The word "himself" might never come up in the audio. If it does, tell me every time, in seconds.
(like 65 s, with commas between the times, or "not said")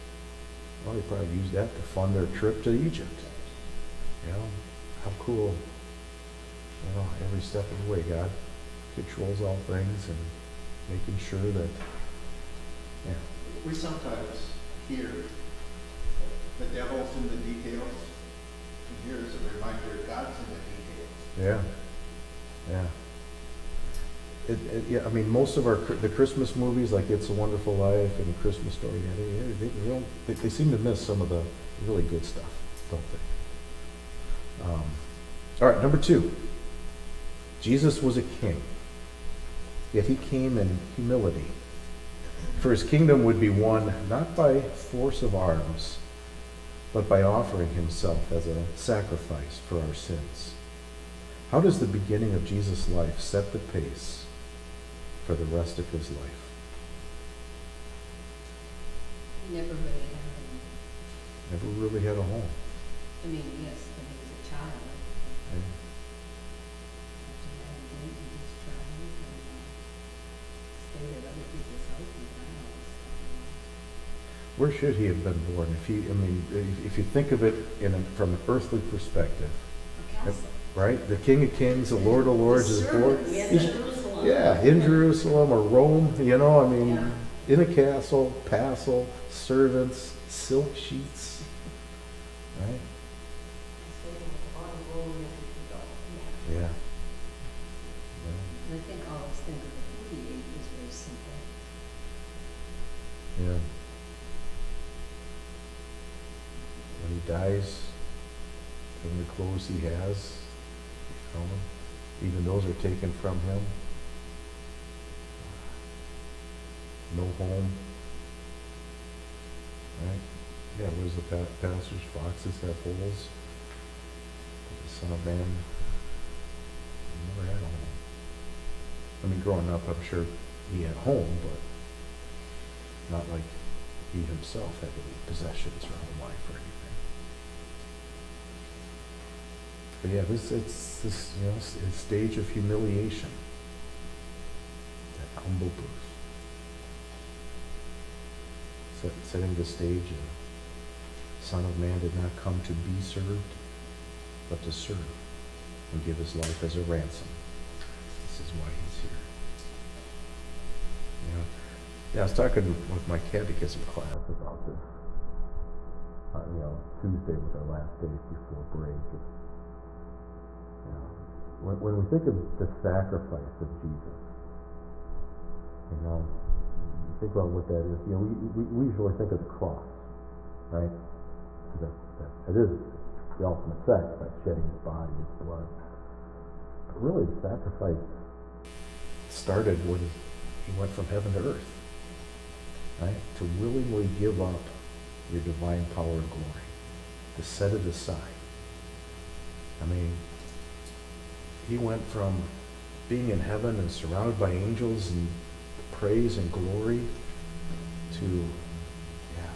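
47 s, 134 s.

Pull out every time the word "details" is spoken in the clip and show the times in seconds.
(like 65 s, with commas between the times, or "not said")
17 s, 21 s.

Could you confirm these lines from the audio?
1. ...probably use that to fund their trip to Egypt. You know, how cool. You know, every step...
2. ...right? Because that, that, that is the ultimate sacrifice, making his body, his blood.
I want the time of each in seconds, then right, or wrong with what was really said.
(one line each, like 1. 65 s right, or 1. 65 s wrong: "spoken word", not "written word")
1. 1 s right
2. 180 s wrong: "shedding", not "making".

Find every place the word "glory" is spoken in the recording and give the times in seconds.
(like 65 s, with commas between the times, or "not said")
196 s, 206 s.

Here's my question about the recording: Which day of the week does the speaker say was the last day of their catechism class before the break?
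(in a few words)
Tuesday.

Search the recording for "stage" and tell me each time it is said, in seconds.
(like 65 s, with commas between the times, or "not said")
141 s, 149 s.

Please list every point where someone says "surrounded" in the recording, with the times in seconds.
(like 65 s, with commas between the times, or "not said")
203 s.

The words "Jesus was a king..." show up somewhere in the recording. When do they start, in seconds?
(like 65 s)
37 s.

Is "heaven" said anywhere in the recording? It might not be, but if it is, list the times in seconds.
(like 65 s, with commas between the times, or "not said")
191 s, 203 s.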